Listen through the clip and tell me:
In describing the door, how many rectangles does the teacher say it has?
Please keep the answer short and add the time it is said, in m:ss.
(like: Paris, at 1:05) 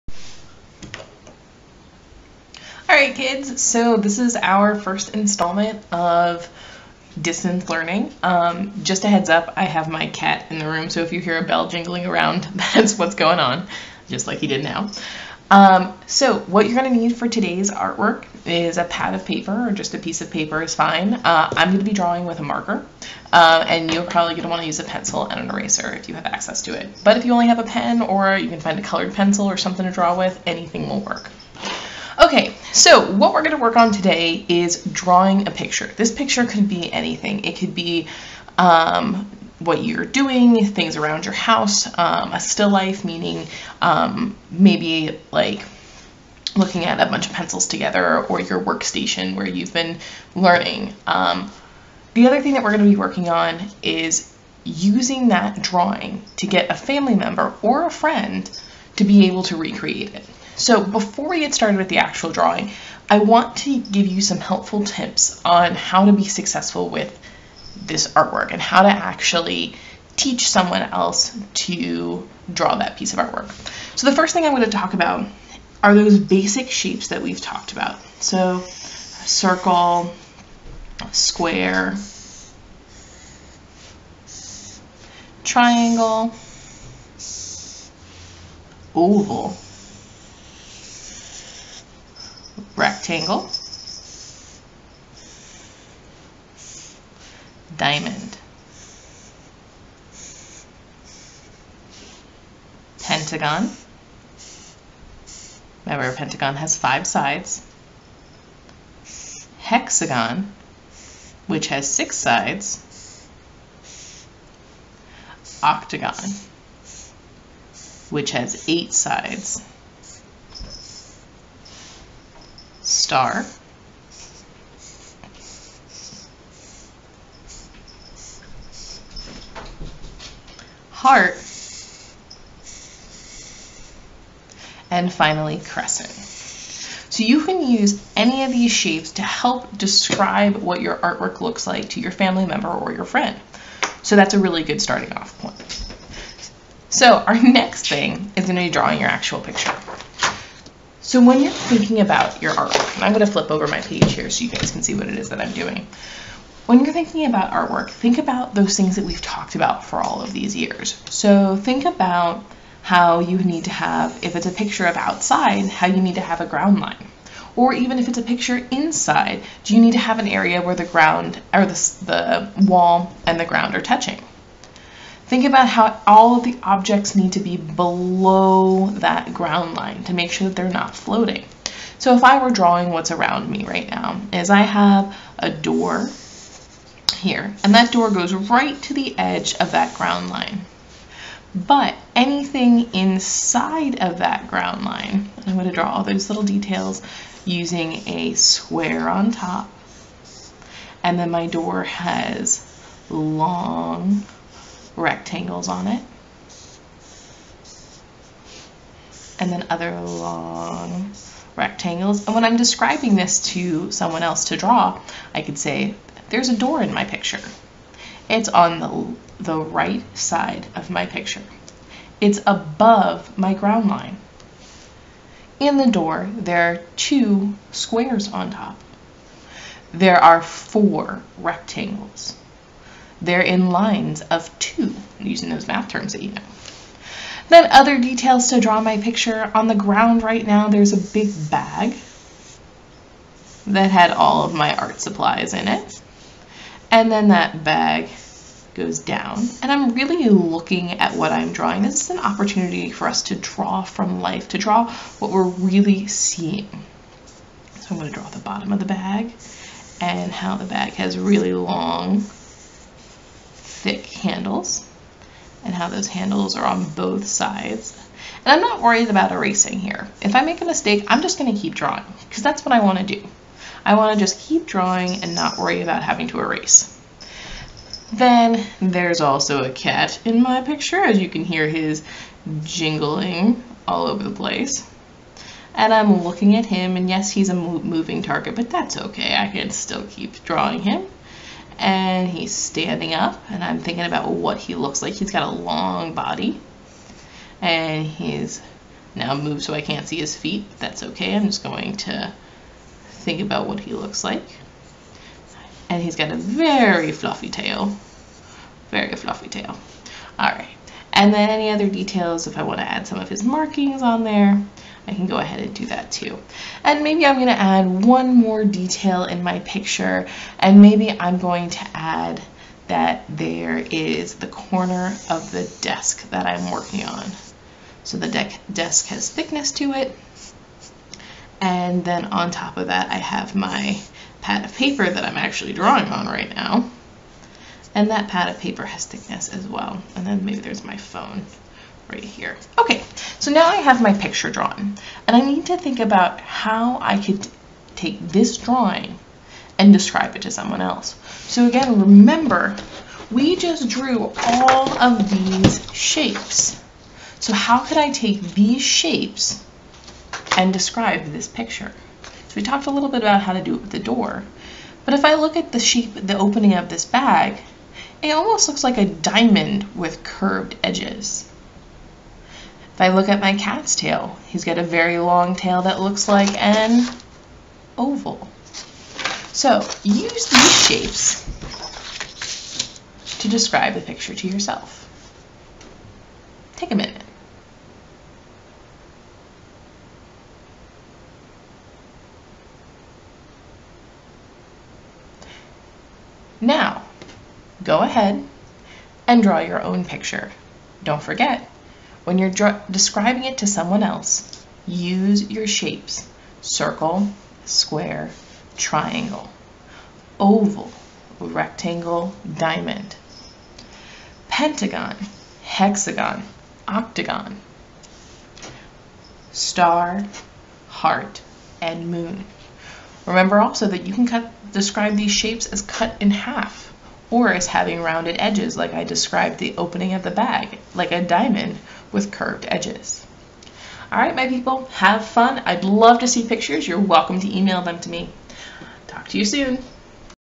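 4, at 3:50.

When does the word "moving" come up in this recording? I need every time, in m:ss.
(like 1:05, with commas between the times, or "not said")
4:47.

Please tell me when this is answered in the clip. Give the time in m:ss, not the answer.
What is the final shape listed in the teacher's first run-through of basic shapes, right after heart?
2:15.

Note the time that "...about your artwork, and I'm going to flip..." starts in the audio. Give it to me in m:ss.
2:31.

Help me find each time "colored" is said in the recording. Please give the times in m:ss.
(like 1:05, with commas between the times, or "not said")
0:28.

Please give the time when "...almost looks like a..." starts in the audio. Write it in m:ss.
6:08.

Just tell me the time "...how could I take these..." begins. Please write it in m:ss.
5:57.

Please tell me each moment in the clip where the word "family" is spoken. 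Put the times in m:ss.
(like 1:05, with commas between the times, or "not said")
0:56, 2:22.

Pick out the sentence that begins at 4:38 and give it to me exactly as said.
Then there's also a cat in my picture, as you can hear his jingling all over the place.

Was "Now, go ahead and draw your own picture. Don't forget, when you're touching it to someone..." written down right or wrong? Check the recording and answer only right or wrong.
wrong.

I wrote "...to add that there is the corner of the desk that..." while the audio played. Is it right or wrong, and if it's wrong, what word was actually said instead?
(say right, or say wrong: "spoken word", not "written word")
right.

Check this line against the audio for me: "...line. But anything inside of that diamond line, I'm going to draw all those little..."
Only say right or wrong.
wrong.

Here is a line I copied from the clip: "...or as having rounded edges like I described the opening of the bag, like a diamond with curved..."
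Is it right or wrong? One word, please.
right.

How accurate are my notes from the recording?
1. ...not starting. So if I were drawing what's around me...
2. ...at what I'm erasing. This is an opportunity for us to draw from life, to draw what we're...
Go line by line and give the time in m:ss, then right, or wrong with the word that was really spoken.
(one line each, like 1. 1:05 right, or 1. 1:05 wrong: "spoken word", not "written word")
1. 3:00 wrong: "floating", not "starting"
2. 4:10 wrong: "drawing", not "erasing".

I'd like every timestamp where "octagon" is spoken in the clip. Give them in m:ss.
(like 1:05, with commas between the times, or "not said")
1:55, 6:56.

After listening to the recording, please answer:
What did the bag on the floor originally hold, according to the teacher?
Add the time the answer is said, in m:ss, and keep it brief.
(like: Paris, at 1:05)
art supplies, at 4:04.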